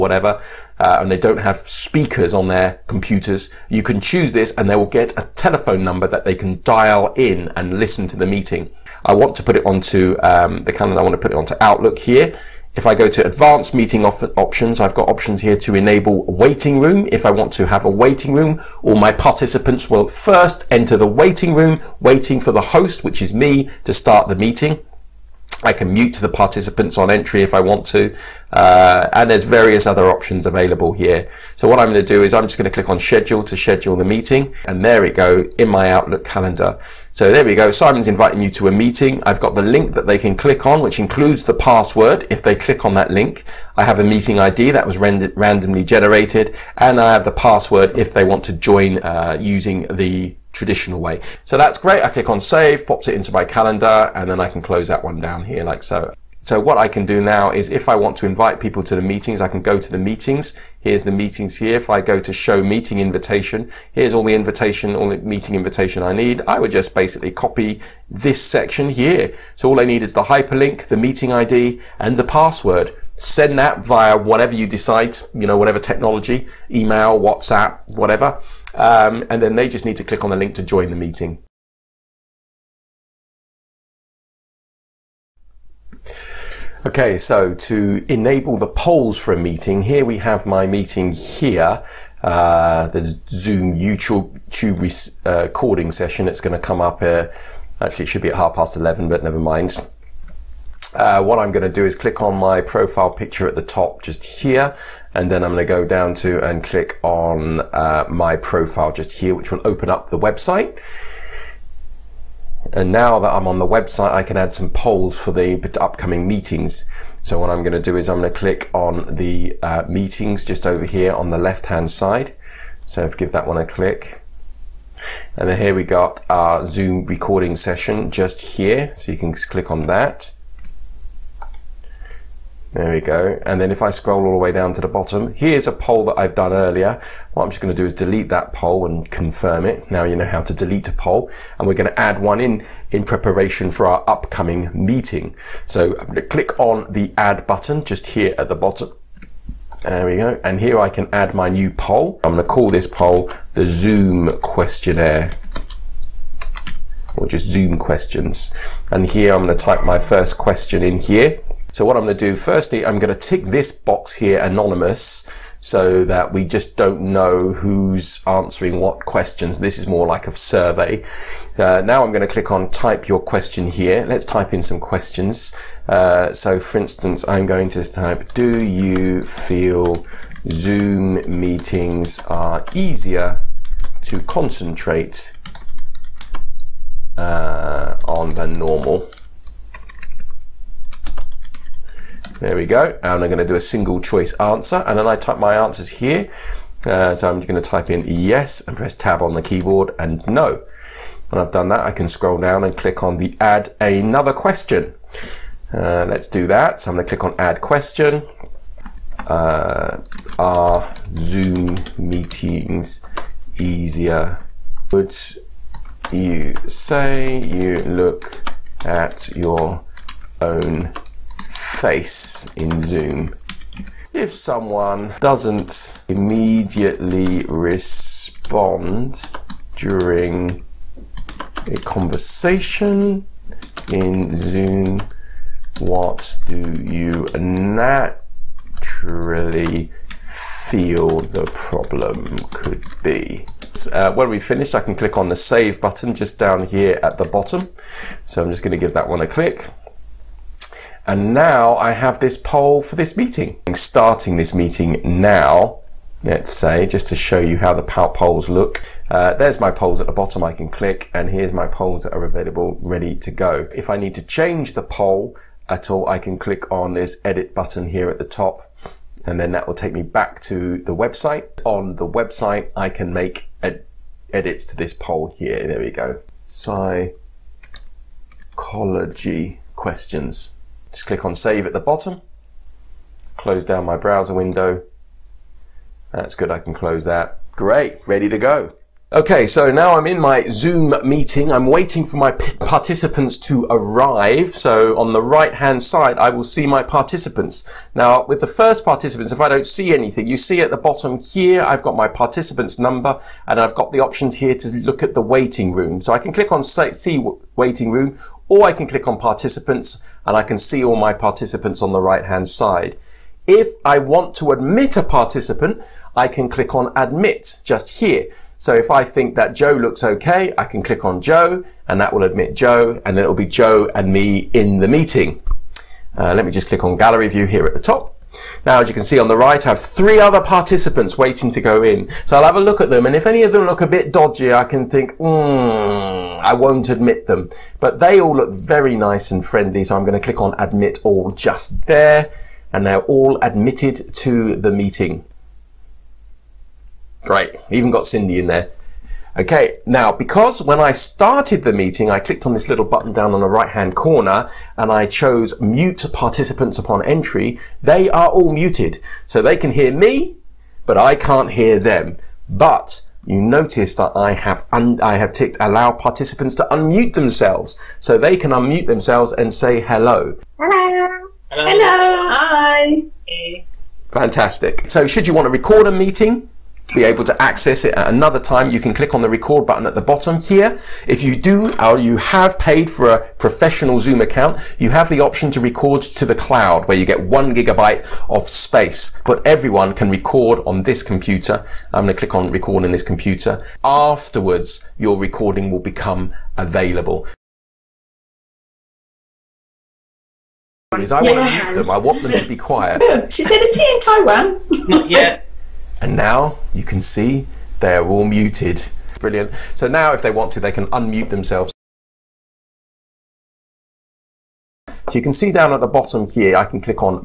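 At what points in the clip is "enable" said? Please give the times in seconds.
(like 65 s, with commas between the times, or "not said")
15 s, 88 s.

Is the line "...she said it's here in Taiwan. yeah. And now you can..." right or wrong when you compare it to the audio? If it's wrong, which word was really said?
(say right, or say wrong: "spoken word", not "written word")
right.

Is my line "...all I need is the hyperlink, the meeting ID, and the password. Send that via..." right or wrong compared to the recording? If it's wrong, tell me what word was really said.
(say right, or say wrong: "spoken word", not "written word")
right.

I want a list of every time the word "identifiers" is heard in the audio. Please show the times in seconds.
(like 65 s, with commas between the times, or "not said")
not said.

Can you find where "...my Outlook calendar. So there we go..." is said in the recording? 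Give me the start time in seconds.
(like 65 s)
35 s.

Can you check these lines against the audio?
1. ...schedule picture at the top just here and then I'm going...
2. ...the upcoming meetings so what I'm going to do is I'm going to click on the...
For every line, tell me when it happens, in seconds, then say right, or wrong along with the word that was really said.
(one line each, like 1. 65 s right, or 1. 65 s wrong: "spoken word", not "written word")
1. 102 s wrong: "profile", not "schedule"
2. 115 s right.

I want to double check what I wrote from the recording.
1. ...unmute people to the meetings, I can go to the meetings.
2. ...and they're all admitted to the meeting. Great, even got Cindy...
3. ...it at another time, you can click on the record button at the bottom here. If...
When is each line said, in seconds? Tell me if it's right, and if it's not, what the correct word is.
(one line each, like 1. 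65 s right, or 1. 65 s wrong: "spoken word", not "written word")
1. 58 s wrong: "invite", not "unmute"
2. 342 s right
3. 377 s right.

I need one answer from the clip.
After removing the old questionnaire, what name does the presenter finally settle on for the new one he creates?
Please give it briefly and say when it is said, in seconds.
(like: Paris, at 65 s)
Zoom questions, at 157 s.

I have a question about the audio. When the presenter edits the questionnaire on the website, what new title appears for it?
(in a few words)
Psychology questions.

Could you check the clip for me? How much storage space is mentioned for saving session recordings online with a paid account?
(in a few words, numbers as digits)
1 gigabyte.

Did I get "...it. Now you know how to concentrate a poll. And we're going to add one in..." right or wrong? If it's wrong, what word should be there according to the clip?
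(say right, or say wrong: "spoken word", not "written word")
wrong: "delete", not "concentrate".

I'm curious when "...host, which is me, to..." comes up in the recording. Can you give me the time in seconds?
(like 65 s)
22 s.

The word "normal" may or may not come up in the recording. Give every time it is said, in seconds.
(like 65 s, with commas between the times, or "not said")
188 s.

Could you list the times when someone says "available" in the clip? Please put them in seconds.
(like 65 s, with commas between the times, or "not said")
30 s, 262 s, 396 s.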